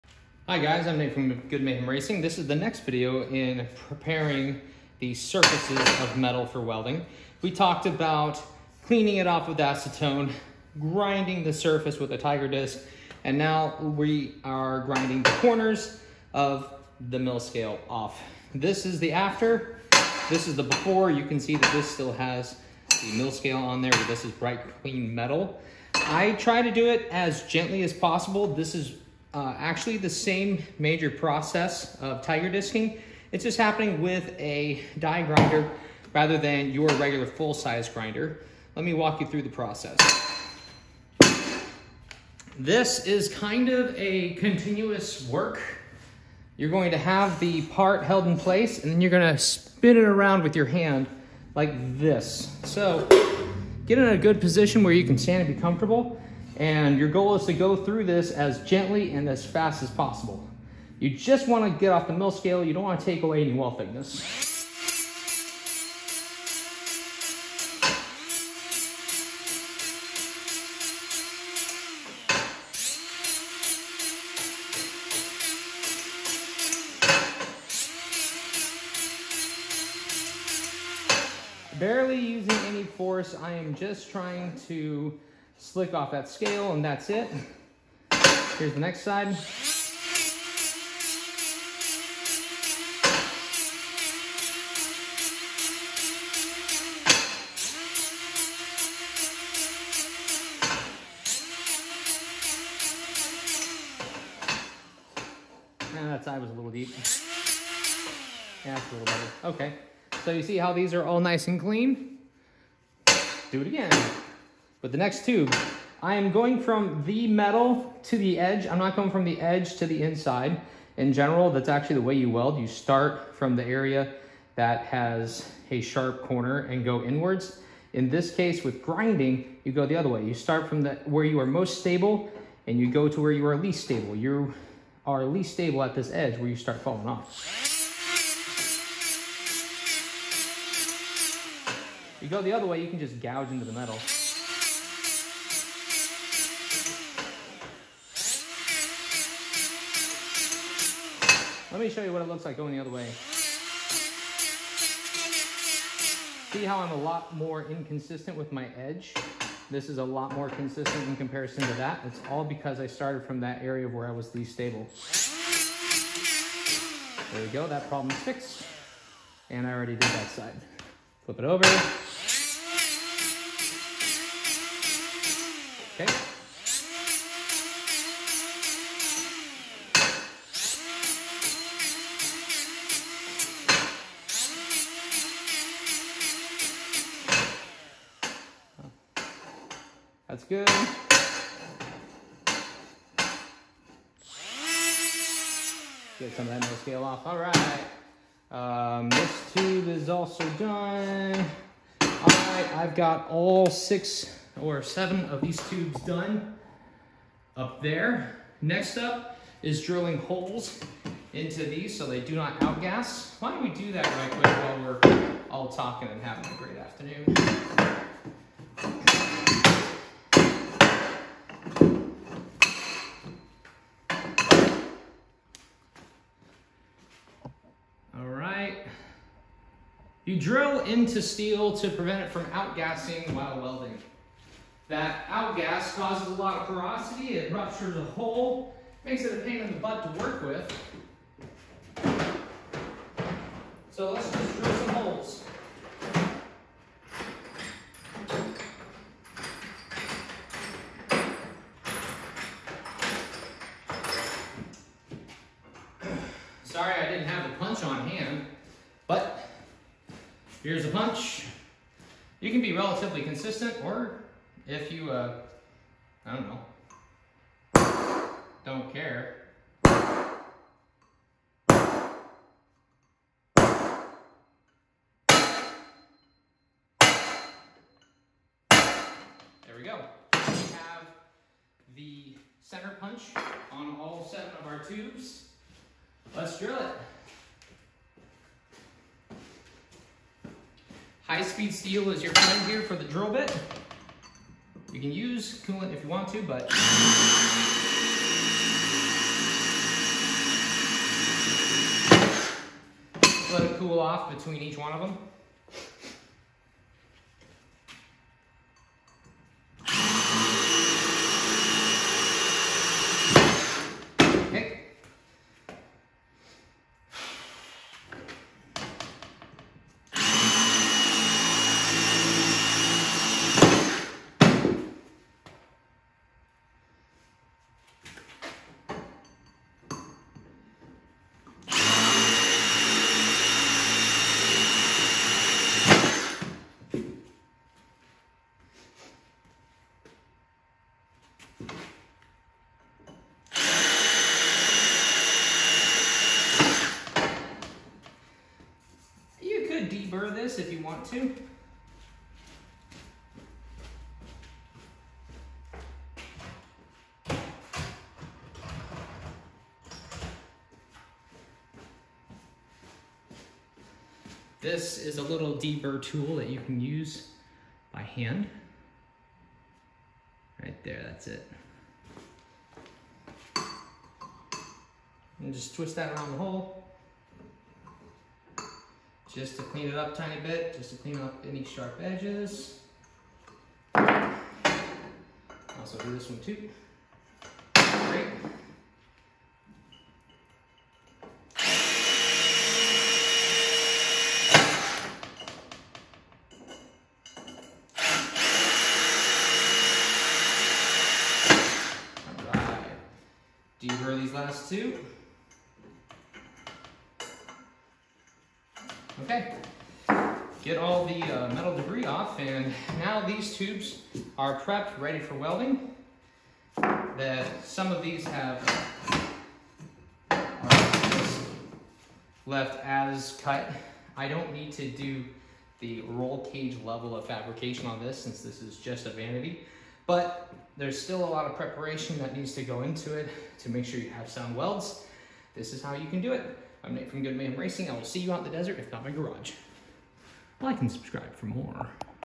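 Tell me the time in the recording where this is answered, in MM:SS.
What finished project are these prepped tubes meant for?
07:09.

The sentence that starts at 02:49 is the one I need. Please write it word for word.
And I already did that side.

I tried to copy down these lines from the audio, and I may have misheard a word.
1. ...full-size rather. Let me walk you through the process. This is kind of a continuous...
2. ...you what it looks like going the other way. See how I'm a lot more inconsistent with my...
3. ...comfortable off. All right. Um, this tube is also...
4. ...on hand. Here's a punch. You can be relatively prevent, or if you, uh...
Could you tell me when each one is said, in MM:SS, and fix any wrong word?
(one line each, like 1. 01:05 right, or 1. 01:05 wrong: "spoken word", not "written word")
1. 00:37 wrong: "grinder", not "rather"
2. 02:32 right
3. 03:16 wrong: "scale", not "comfortable"
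4. 04:17 wrong: "consistent", not "prevent".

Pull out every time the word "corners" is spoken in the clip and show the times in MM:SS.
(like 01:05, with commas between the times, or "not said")
00:15, 02:06.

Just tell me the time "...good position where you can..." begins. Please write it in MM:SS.
00:54.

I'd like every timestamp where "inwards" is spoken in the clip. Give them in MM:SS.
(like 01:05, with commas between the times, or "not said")
02:07.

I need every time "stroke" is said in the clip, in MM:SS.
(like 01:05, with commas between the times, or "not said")
not said.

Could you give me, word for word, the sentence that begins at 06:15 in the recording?
And just twist that around the hole just to clean it up tiny bit, just to clean up any sharp edges.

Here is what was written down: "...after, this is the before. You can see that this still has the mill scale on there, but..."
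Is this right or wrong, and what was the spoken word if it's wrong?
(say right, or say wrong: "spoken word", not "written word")
right.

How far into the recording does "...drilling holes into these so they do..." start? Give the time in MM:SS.
03:29.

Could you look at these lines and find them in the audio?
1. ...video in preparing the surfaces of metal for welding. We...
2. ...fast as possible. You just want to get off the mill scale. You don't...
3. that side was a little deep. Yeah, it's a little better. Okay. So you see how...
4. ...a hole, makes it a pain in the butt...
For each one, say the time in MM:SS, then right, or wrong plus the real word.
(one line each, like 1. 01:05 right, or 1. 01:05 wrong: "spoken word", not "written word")
1. 00:02 right
2. 00:59 right
3. 01:46 right
4. 03:57 right.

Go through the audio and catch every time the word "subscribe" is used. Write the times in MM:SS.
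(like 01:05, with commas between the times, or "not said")
07:20.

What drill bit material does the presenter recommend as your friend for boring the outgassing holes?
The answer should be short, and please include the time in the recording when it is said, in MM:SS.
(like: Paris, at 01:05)
High-speed steel, at 04:51.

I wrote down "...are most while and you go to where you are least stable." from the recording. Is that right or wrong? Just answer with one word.
wrong.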